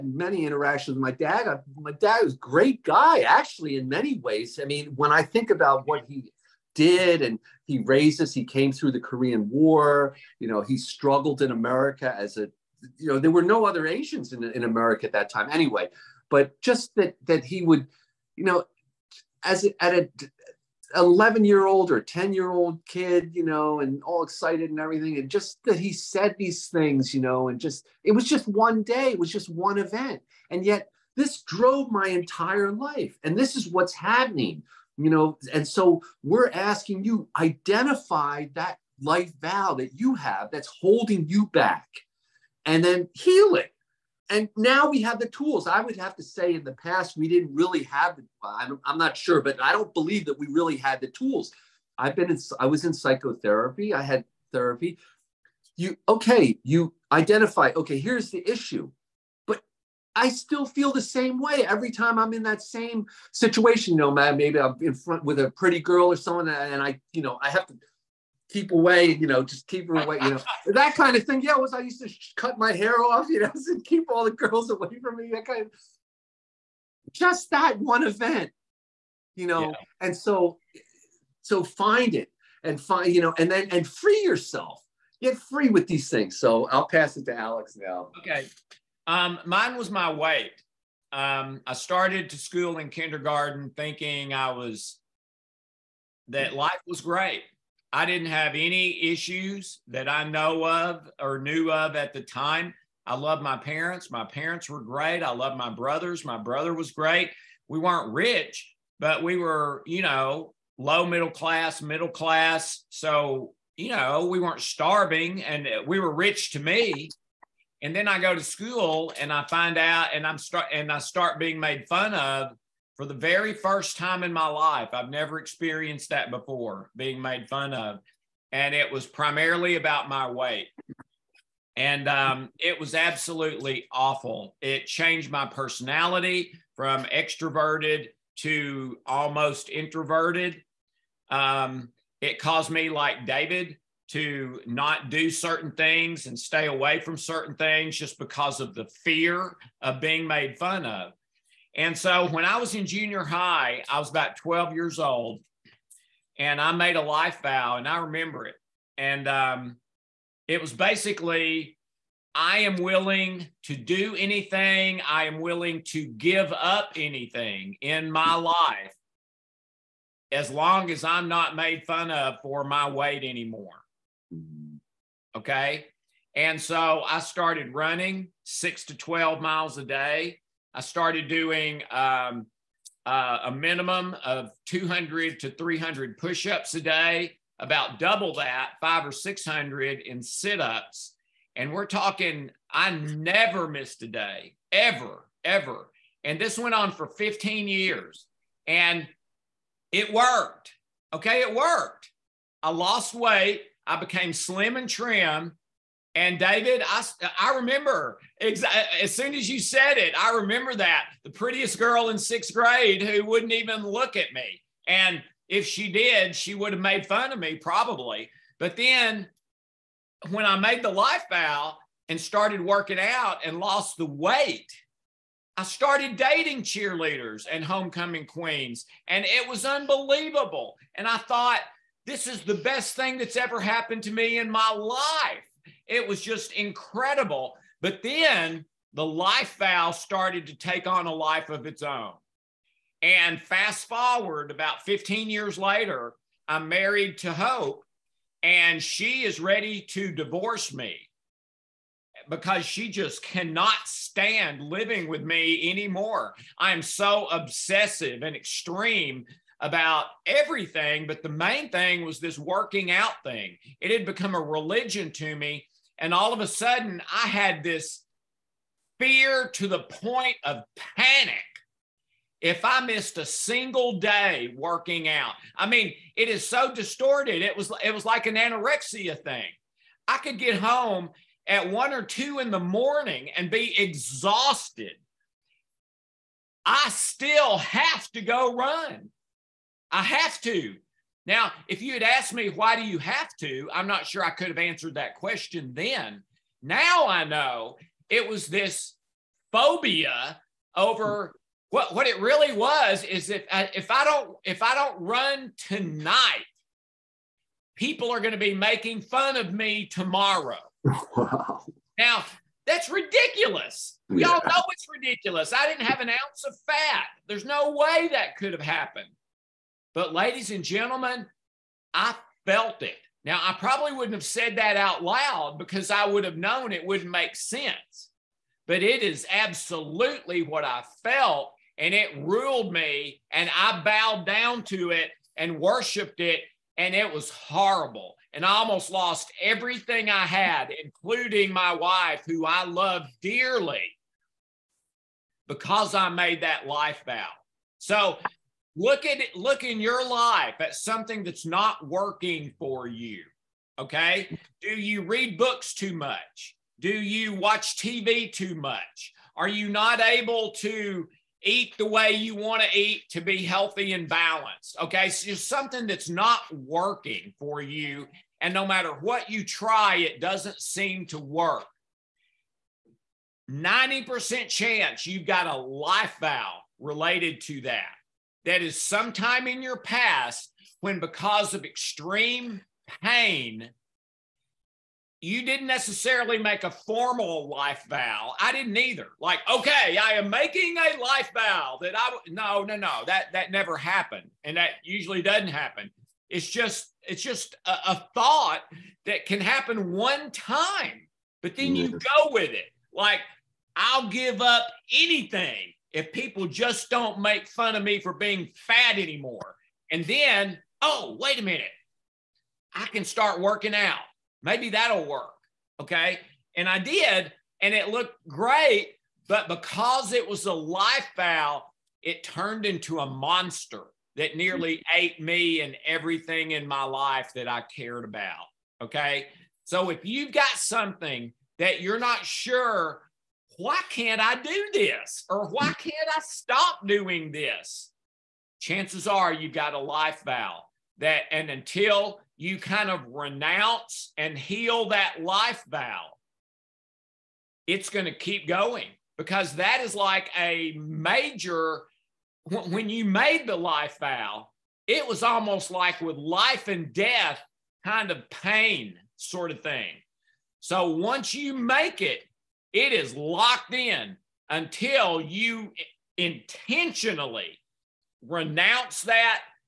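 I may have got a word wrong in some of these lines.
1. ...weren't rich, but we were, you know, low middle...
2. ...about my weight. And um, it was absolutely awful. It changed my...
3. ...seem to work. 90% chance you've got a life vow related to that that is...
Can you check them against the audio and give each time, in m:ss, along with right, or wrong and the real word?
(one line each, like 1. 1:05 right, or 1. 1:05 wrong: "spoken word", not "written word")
1. 1:47 right
2. 2:09 right
3. 6:10 right.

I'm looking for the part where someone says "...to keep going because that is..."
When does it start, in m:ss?
7:28.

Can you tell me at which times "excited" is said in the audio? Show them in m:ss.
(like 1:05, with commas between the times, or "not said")
0:24.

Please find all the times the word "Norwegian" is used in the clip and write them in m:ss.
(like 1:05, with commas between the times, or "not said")
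not said.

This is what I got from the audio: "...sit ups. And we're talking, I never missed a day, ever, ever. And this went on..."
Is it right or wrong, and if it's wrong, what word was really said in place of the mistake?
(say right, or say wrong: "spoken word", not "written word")
right.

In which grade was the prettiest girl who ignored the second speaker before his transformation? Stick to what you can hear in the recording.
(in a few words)
sixth grade.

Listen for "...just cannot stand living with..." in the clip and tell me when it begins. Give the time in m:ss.
4:12.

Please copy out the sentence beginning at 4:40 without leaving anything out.
I could get home at one or two in the morning and be exhausted.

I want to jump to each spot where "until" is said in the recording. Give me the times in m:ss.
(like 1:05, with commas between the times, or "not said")
7:21, 7:44.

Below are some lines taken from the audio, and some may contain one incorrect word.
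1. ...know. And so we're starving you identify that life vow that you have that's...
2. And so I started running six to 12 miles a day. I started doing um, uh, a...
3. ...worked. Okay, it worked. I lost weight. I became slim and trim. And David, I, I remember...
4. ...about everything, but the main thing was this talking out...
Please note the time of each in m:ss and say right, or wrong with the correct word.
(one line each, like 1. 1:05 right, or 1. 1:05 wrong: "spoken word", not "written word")
1. 0:35 wrong: "asking", not "starving"
2. 2:56 right
3. 3:20 right
4. 4:19 wrong: "working", not "talking".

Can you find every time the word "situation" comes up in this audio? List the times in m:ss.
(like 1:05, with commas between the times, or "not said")
1:03.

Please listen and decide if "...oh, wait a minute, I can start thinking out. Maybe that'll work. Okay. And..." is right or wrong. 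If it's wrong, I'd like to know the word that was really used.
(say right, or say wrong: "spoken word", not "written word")
wrong: "working", not "thinking".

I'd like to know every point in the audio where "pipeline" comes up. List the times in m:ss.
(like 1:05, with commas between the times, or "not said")
not said.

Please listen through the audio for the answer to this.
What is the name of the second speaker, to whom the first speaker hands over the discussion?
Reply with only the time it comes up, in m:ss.
1:27.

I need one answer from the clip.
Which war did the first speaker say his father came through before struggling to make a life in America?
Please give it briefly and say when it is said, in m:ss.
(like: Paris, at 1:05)
Korean War, at 0:09.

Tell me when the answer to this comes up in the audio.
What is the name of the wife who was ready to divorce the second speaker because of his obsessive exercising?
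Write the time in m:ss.
4:07.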